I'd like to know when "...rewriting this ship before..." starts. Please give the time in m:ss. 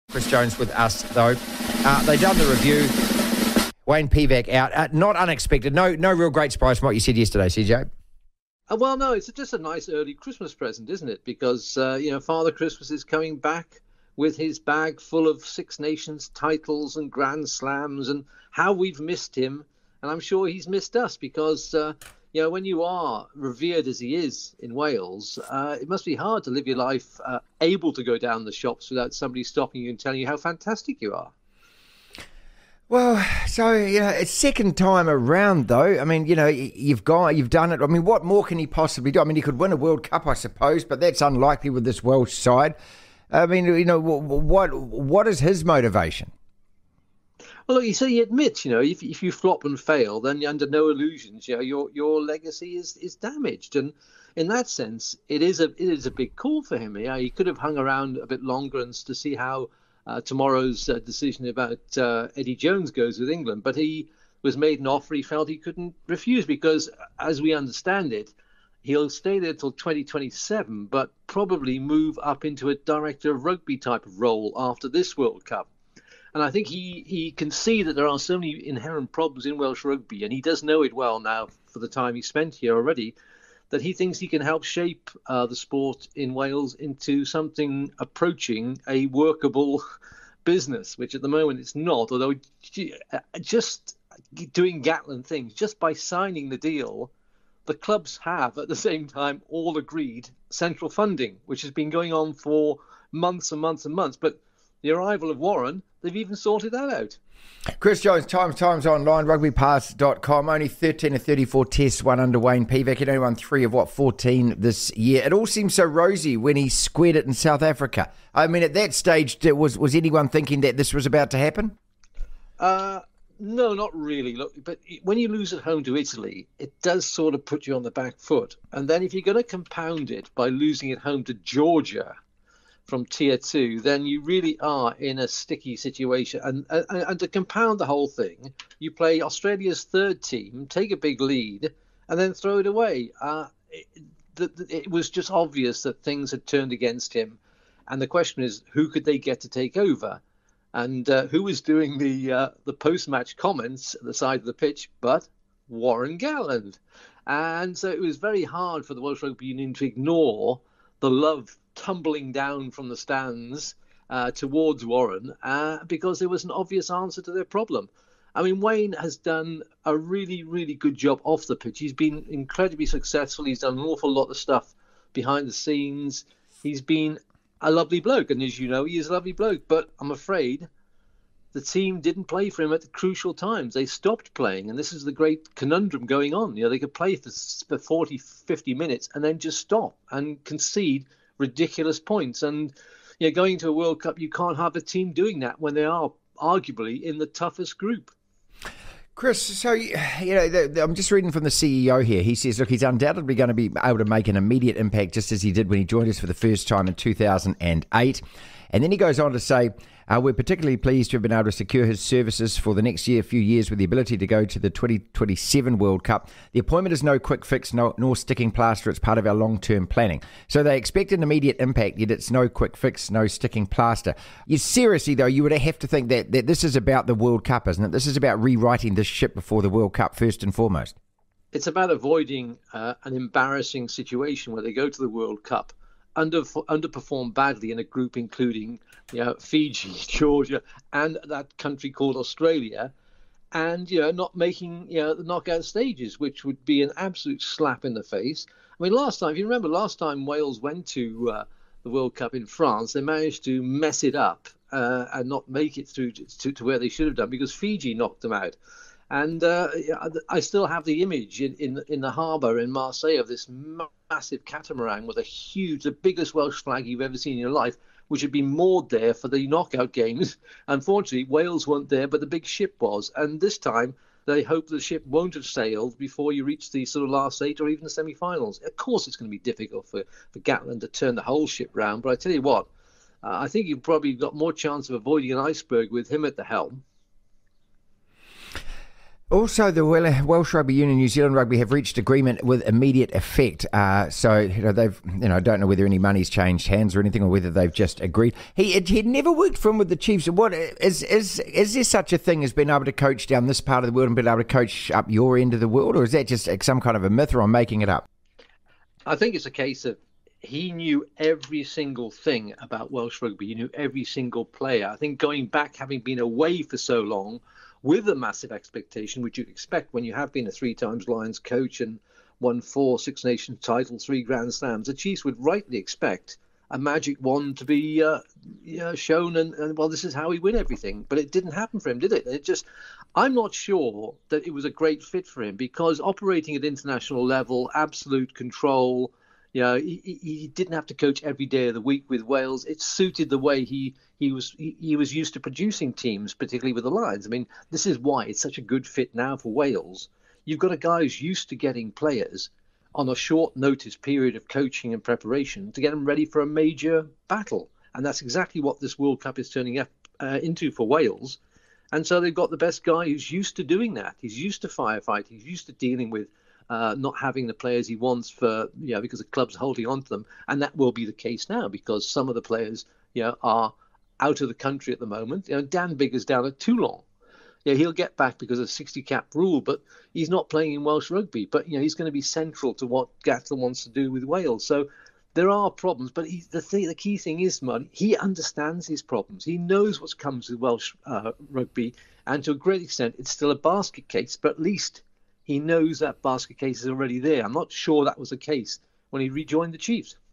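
3:48.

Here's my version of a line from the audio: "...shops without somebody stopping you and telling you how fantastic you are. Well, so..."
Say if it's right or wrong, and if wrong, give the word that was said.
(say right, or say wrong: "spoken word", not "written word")
right.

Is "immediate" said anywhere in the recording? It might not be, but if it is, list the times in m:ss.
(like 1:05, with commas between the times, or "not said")
3:24, 3:41, 4:52.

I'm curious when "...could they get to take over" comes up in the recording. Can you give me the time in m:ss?
2:28.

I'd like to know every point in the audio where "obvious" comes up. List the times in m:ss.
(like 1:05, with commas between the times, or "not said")
2:25, 2:46.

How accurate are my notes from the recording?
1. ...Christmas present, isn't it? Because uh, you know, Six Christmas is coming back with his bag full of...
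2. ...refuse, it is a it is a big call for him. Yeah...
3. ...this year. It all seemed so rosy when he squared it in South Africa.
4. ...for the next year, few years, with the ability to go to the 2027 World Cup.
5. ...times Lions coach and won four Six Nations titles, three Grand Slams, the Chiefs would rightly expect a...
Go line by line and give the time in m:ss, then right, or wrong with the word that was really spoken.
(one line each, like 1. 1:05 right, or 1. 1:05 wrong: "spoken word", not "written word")
1. 0:10 wrong: "Father", not "Six"
2. 0:54 wrong: "sense", not "refuse"
3. 1:54 right
4. 3:32 right
5. 5:20 right.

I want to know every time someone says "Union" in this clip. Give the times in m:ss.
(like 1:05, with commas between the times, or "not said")
2:39, 4:50.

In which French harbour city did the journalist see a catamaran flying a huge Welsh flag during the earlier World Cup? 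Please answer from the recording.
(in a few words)
Marseille.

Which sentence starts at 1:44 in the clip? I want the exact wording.
But the arrival of Warren, they've even sorted that out.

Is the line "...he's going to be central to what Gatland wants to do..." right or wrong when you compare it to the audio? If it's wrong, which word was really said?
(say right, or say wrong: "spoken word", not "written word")
right.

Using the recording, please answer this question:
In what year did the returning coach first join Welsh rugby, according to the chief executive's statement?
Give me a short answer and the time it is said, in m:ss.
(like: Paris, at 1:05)
2008, at 3:26.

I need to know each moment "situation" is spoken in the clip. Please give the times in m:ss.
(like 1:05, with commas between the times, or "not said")
2:15, 3:53.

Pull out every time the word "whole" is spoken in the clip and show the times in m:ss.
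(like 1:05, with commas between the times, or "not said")
2:17, 4:41.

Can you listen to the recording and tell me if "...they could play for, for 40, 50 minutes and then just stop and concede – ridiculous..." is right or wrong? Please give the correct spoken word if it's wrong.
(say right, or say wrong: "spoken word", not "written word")
right.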